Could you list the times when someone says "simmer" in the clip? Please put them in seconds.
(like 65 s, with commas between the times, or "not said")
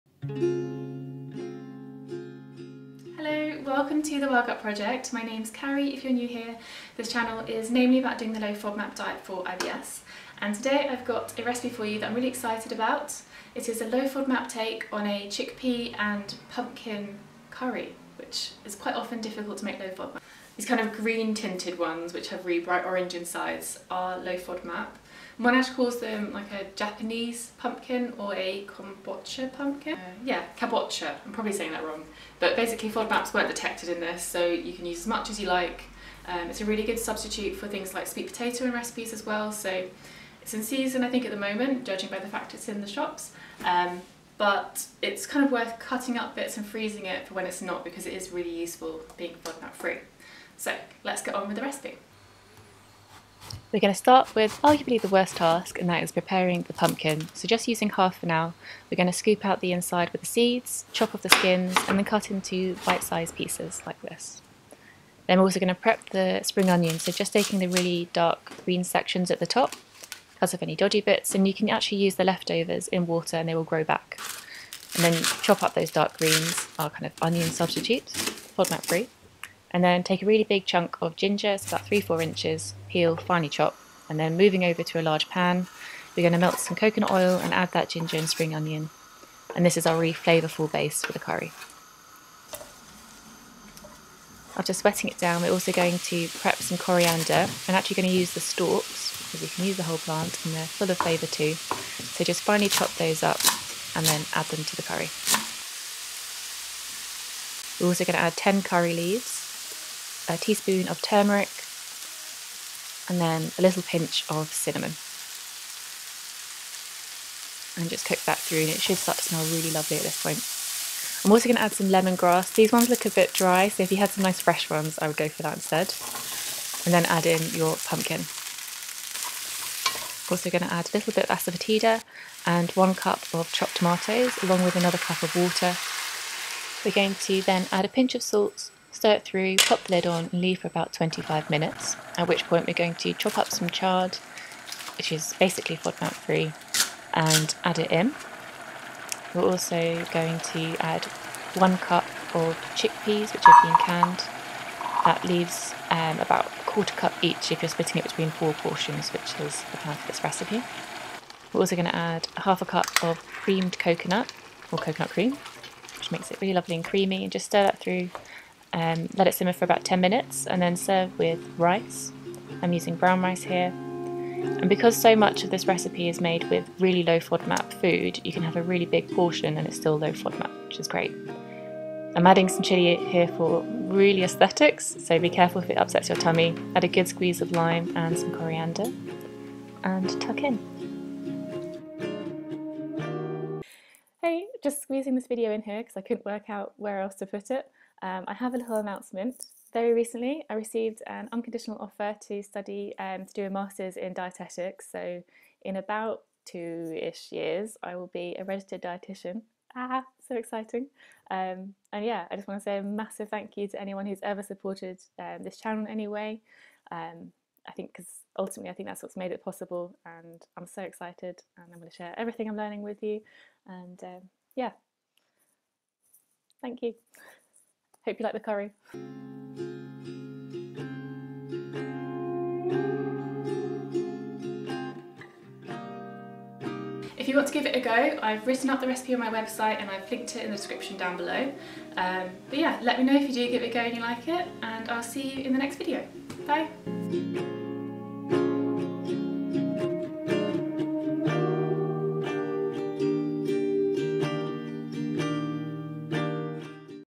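169 s.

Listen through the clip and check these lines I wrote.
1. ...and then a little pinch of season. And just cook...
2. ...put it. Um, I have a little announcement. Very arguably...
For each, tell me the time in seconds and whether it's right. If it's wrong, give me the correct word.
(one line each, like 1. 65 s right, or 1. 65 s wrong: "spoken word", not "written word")
1. 113 s wrong: "cinnamon", not "season"
2. 197 s wrong: "recently", not "arguably".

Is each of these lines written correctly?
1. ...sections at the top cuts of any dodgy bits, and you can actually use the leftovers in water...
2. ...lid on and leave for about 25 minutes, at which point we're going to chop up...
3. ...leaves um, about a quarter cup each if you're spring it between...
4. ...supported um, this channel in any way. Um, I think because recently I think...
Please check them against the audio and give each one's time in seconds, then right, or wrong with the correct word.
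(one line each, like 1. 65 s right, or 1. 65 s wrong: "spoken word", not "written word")
1. 68 s right
2. 139 s right
3. 155 s wrong: "splitting", not "spring"
4. 214 s wrong: "ultimately", not "recently".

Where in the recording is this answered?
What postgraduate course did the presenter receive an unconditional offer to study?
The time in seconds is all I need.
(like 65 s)
203 s.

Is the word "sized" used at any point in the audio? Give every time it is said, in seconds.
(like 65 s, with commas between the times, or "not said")
63 s.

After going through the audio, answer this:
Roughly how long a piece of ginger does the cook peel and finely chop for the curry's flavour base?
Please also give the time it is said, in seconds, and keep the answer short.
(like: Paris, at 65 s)
3-4 inches, at 81 s.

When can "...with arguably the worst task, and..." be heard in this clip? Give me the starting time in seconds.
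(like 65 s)
54 s.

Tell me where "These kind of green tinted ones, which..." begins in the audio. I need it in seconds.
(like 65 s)
20 s.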